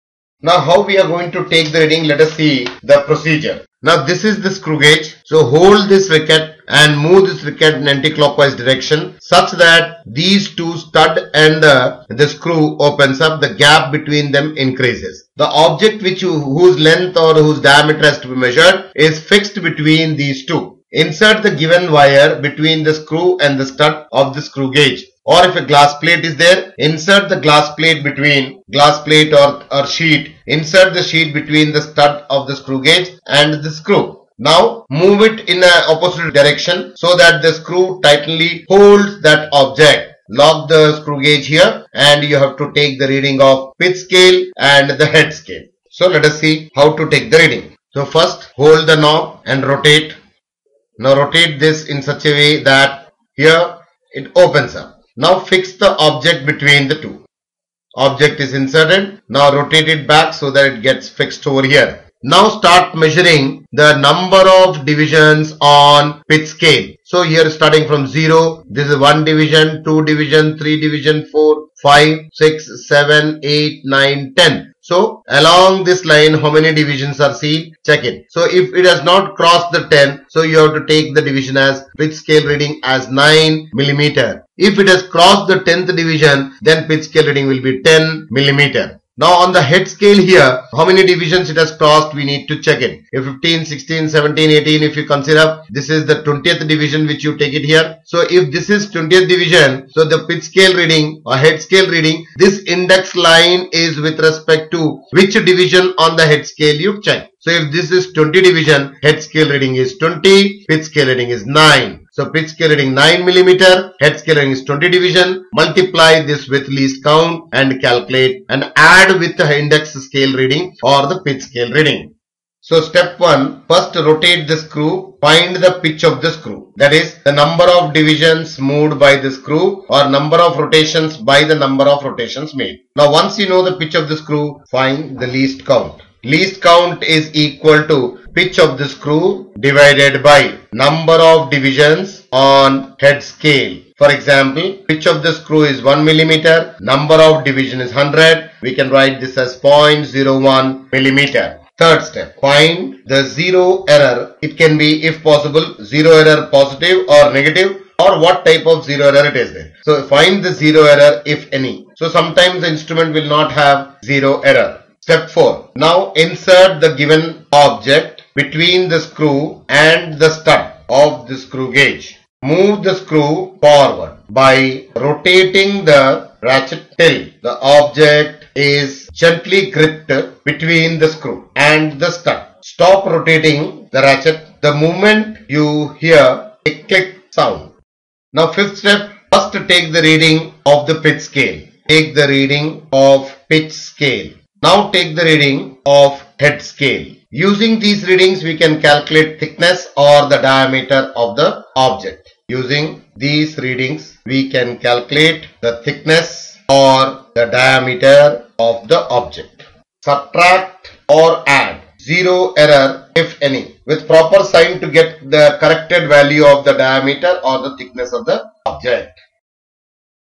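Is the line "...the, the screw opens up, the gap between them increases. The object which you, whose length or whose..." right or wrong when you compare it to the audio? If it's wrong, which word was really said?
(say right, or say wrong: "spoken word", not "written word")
right.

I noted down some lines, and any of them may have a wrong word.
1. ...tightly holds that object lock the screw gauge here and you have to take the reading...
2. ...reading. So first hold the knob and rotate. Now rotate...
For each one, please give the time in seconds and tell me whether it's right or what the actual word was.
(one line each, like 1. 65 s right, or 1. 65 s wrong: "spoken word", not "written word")
1. 38 s right
2. 47 s right.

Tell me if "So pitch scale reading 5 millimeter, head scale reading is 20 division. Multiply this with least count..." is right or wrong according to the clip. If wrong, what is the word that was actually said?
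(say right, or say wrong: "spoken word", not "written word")
wrong: "9", not "5".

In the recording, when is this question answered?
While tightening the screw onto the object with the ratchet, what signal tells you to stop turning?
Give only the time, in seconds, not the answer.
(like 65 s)
186 s.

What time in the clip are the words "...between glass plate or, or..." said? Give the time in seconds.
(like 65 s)
28 s.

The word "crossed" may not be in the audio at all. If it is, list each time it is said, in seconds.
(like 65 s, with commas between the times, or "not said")
79 s, 85 s, 91 s.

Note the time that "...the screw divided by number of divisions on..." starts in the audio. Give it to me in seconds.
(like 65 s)
138 s.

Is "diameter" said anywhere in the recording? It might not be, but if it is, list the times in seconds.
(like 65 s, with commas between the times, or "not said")
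17 s, 200 s, 207 s, 216 s.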